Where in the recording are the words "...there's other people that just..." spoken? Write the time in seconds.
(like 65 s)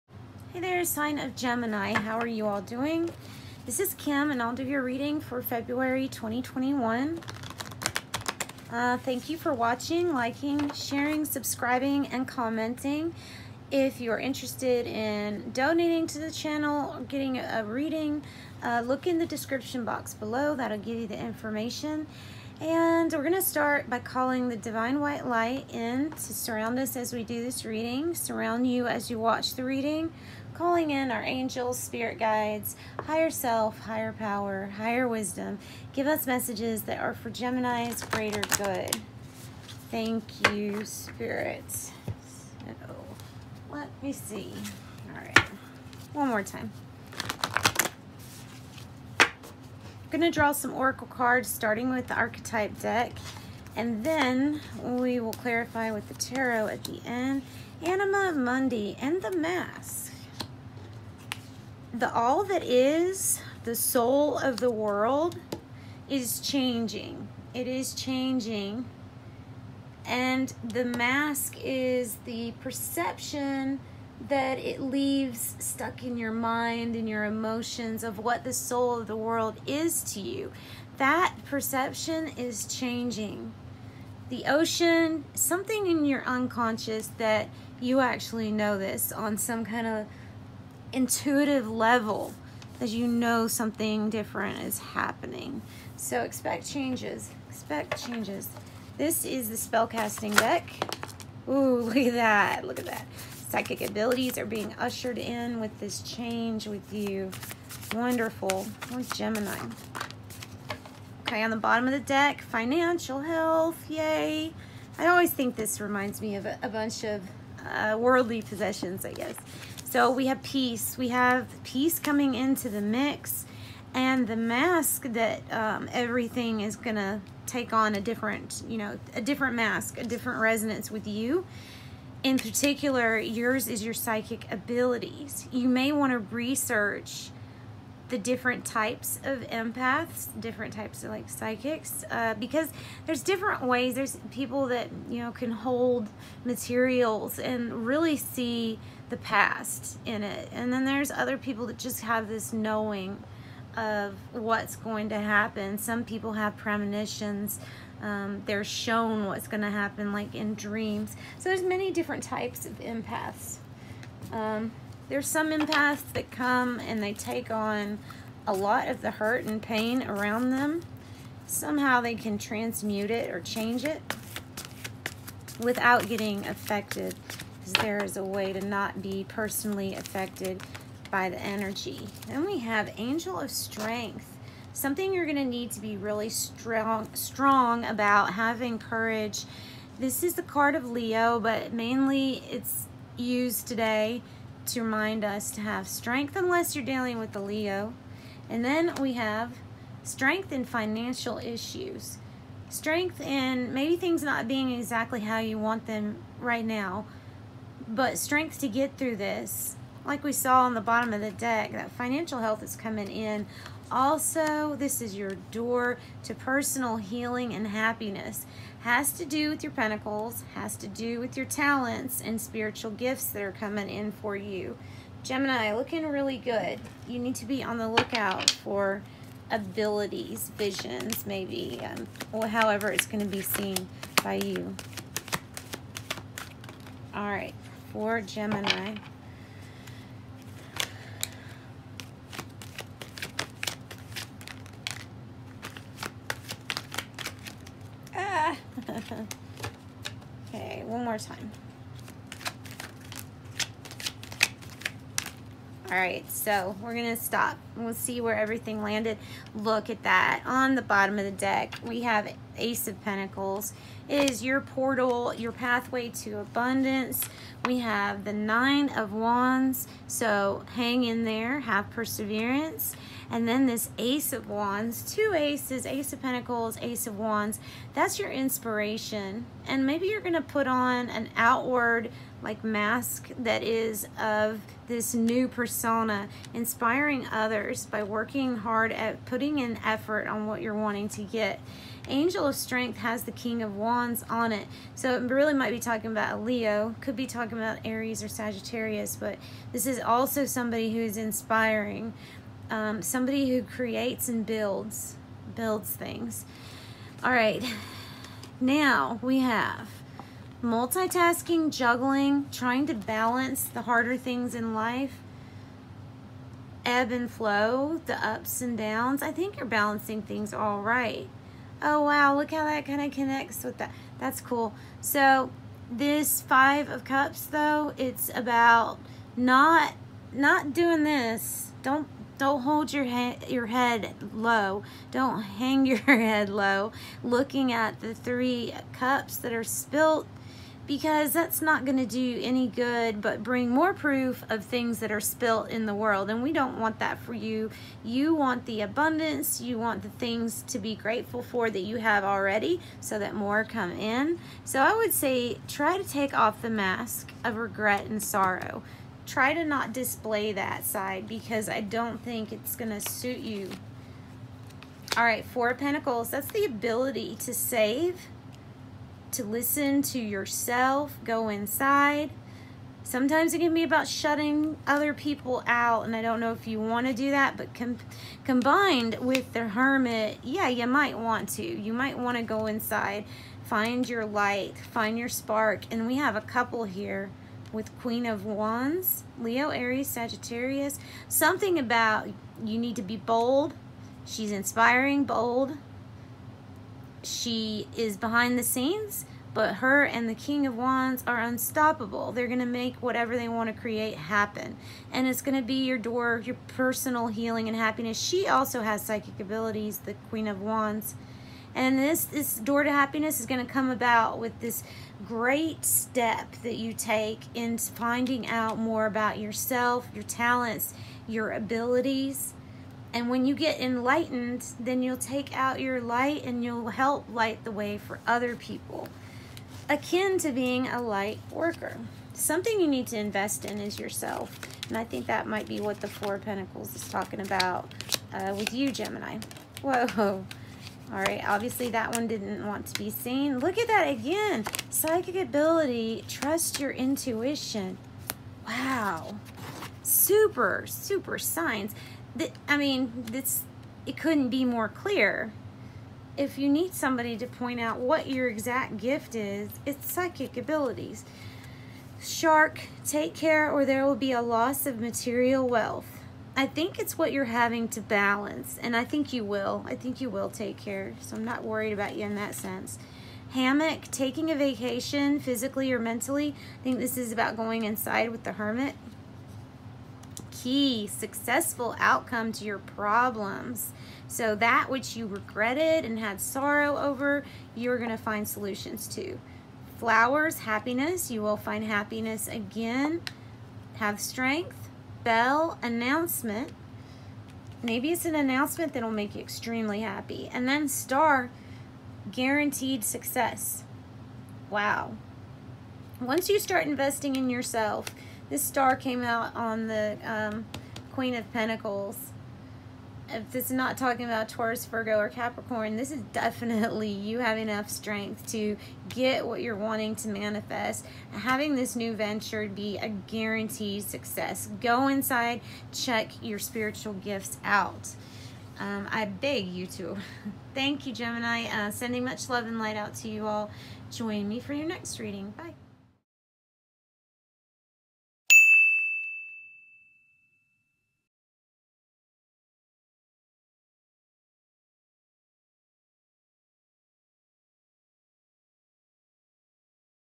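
150 s.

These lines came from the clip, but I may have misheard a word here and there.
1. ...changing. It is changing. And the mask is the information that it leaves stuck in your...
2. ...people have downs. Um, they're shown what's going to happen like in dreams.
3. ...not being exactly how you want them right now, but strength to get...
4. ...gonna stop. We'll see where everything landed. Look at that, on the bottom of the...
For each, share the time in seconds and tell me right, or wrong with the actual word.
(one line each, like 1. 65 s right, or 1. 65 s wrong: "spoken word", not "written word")
1. 66 s wrong: "perception", not "information"
2. 156 s wrong: "premonitions", not "downs"
3. 204 s right
4. 256 s right.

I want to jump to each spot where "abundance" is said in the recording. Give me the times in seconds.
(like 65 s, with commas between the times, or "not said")
266 s, 348 s.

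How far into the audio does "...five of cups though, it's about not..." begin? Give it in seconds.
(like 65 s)
326 s.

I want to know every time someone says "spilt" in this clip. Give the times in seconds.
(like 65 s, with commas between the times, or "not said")
339 s, 345 s.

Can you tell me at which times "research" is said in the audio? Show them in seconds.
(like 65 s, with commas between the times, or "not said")
136 s.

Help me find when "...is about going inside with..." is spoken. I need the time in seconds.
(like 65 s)
477 s.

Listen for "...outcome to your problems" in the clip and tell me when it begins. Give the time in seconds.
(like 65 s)
481 s.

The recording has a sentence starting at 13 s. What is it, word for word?
If you're interested in donating to the channel or getting a reading, uh, look in the description box below.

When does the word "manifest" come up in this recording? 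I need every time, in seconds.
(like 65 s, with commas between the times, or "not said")
520 s.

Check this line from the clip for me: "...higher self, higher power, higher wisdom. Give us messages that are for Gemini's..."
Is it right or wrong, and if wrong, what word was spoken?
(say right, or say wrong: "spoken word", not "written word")
right.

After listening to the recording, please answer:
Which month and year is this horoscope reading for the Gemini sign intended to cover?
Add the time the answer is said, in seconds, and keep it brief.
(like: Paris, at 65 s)
February 2021, at 5 s.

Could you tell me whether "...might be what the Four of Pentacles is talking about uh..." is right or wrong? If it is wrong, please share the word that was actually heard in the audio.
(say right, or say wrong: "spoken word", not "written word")
right.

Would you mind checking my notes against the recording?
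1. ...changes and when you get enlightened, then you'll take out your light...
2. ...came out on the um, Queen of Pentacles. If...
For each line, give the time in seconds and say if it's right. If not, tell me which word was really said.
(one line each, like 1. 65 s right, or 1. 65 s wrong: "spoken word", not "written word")
1. 421 s wrong: "abilities", not "changes"
2. 508 s right.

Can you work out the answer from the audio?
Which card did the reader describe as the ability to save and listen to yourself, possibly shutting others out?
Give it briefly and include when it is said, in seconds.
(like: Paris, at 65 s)
Four Pentacles, at 365 s.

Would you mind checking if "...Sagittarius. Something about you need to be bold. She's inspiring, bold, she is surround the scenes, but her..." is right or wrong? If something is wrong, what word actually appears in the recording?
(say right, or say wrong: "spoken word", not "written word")
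wrong: "behind", not "surround".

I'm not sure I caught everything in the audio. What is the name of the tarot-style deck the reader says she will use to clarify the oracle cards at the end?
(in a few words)
Anima Mundi.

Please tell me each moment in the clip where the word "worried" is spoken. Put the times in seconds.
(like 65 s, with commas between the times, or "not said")
471 s.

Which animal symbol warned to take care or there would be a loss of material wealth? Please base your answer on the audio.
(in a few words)
Shark.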